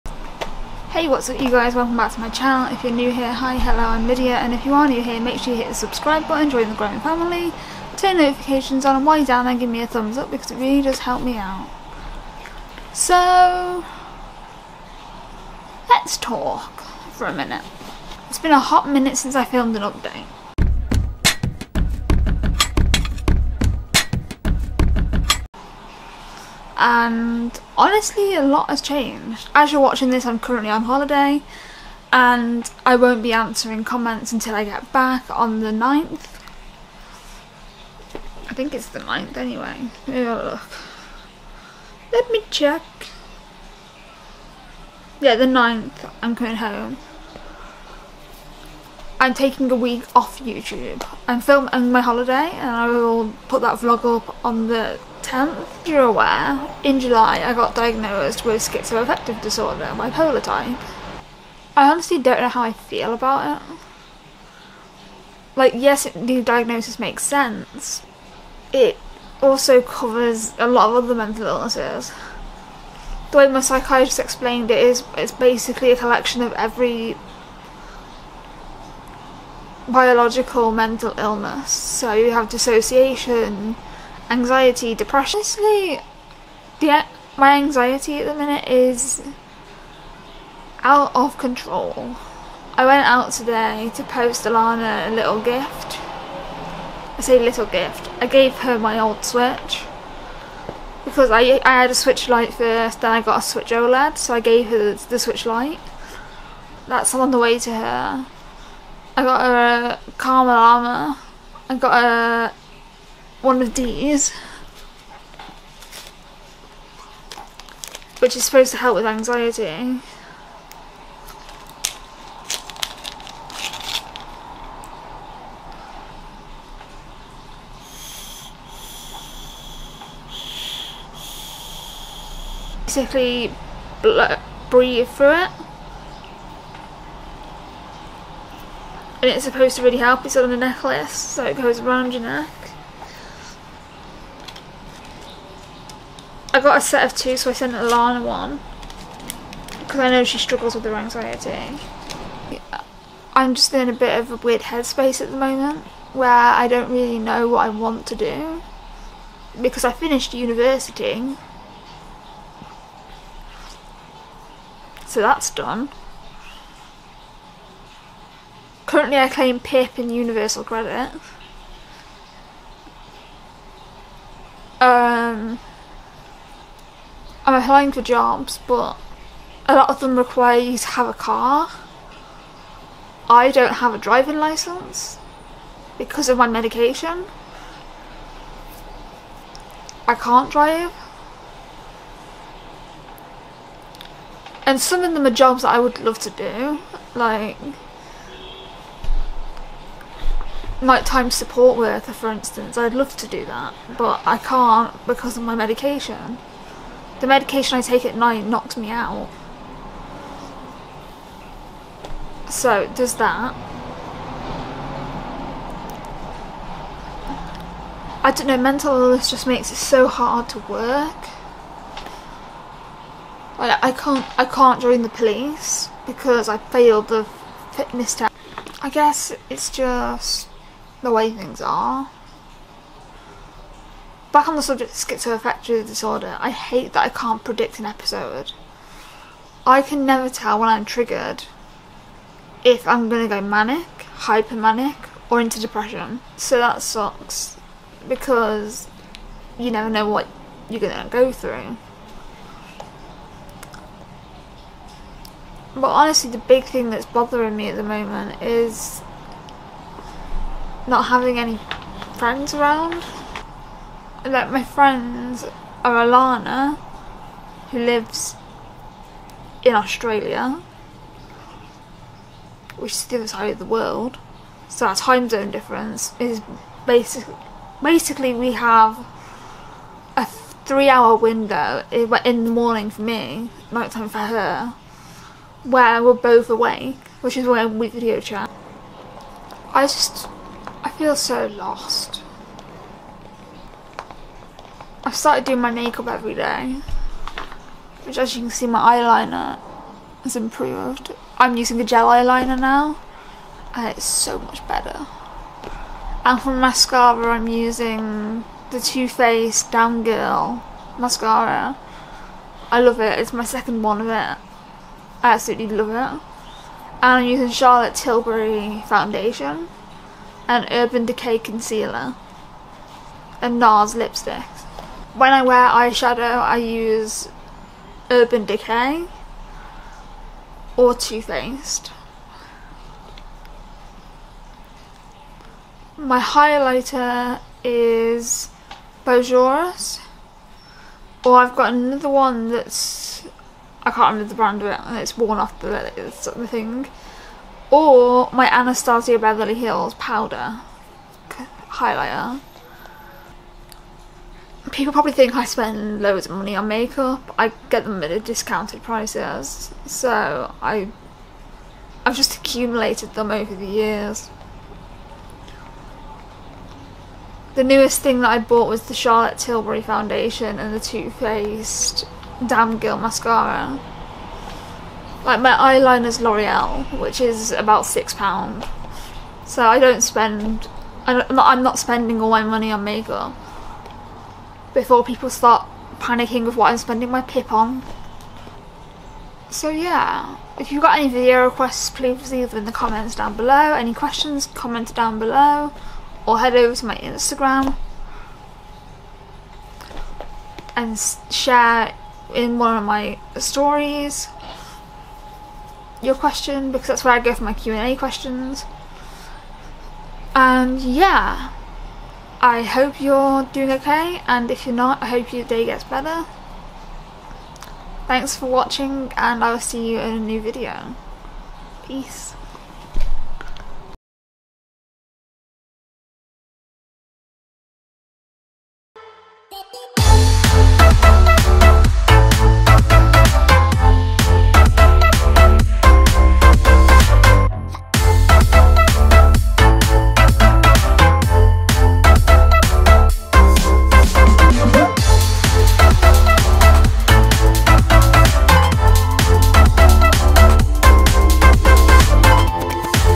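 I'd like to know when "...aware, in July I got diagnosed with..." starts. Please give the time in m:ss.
0:56.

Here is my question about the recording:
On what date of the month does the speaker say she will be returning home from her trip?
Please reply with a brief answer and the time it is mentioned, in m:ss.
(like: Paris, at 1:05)
9th, at 0:45.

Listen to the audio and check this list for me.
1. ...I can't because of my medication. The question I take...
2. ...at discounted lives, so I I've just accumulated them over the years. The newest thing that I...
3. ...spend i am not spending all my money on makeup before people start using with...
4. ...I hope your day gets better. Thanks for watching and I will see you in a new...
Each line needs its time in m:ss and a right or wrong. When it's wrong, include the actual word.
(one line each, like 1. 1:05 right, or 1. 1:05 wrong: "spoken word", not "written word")
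1. 3:24 wrong: "medication", not "question"
2. 5:58 wrong: "prices", not "lives"
3. 6:21 wrong: "panicking", not "using"
4. 6:55 right.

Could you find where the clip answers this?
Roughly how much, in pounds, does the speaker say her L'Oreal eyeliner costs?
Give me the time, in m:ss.
6:17.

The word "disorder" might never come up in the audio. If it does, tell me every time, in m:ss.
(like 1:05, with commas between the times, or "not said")
0:59, 3:55.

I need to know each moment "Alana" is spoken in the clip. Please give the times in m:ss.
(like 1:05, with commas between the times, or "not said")
1:34, 2:27, 4:26.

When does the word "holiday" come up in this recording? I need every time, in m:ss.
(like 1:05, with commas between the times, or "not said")
0:30, 0:52.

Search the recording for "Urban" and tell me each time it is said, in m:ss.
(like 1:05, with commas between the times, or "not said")
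5:20, 5:28.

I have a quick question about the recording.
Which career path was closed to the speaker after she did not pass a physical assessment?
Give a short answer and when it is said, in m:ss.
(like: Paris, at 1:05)
The police, at 3:44.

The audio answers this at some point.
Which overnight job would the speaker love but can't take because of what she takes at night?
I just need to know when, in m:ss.
3:20.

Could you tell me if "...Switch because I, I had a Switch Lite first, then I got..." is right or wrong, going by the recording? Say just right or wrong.
right.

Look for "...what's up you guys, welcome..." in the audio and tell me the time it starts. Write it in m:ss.
0:01.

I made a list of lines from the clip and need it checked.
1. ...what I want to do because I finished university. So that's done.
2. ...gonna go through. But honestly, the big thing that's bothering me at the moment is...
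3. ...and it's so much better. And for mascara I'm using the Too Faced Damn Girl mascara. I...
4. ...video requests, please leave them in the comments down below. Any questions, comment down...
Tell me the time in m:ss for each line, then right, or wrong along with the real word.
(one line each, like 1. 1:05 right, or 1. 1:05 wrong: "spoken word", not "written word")
1. 2:37 right
2. 4:10 right
3. 5:03 right
4. 6:31 right.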